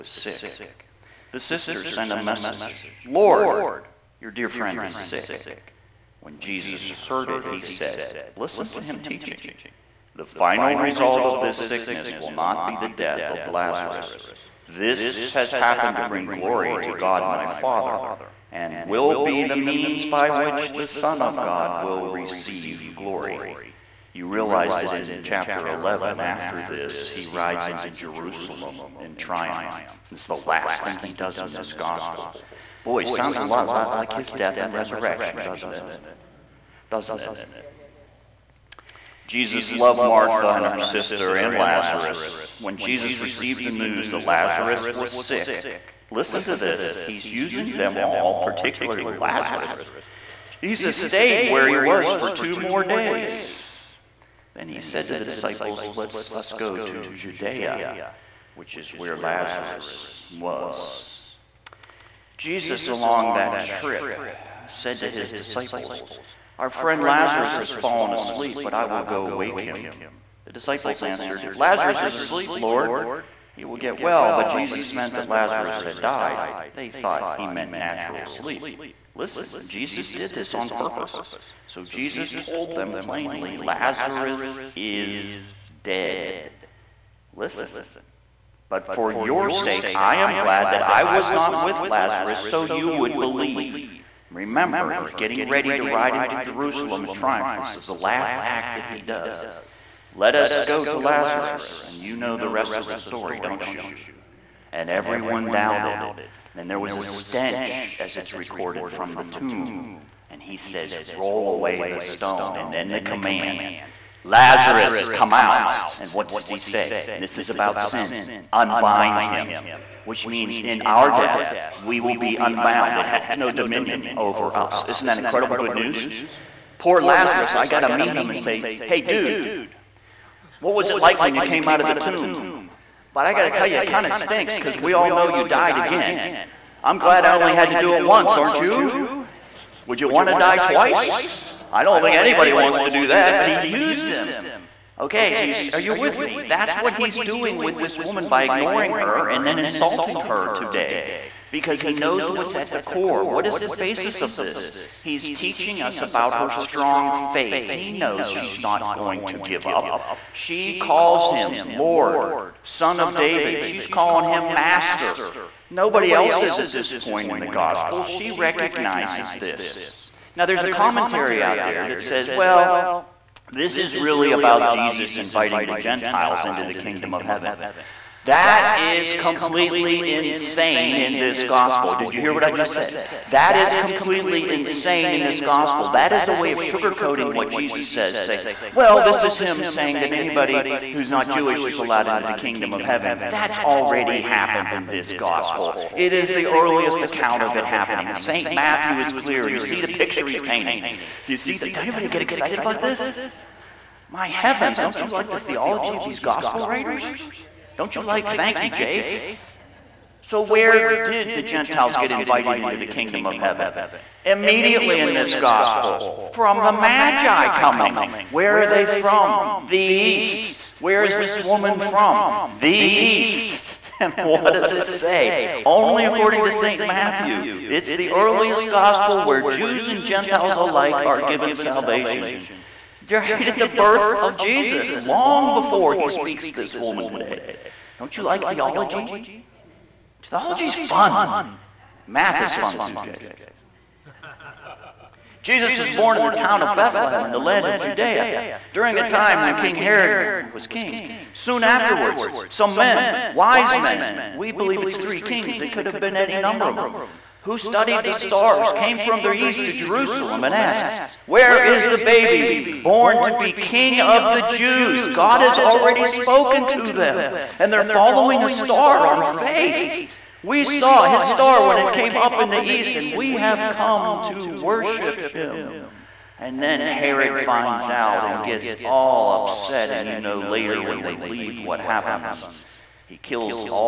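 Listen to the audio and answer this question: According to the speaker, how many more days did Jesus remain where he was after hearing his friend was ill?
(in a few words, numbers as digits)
2.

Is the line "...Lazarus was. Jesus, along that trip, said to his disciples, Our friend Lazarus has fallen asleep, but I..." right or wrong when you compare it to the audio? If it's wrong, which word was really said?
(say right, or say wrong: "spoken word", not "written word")
right.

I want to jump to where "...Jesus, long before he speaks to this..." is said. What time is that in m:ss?
3:54.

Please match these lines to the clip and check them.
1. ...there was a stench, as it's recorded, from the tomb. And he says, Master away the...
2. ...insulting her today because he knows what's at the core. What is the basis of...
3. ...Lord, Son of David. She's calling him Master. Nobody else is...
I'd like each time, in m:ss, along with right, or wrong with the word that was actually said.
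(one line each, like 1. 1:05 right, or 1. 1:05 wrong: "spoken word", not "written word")
1. 1:46 wrong: "Roll", not "Master"
2. 2:29 right
3. 2:41 right.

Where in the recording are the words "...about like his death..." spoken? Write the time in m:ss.
0:33.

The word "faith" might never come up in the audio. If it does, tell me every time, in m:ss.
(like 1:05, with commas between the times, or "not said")
2:37, 4:29.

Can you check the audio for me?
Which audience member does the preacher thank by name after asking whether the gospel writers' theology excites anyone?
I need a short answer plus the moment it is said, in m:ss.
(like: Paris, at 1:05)
Jace, at 3:28.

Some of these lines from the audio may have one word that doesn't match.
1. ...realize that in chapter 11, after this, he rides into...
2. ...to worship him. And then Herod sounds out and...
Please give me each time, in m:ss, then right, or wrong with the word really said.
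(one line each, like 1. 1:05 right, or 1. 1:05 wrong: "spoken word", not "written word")
1. 0:24 right
2. 4:34 wrong: "finds", not "sounds".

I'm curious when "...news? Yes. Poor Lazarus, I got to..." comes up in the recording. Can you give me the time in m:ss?
2:05.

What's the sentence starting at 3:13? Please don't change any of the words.
That's already happened in this gospel.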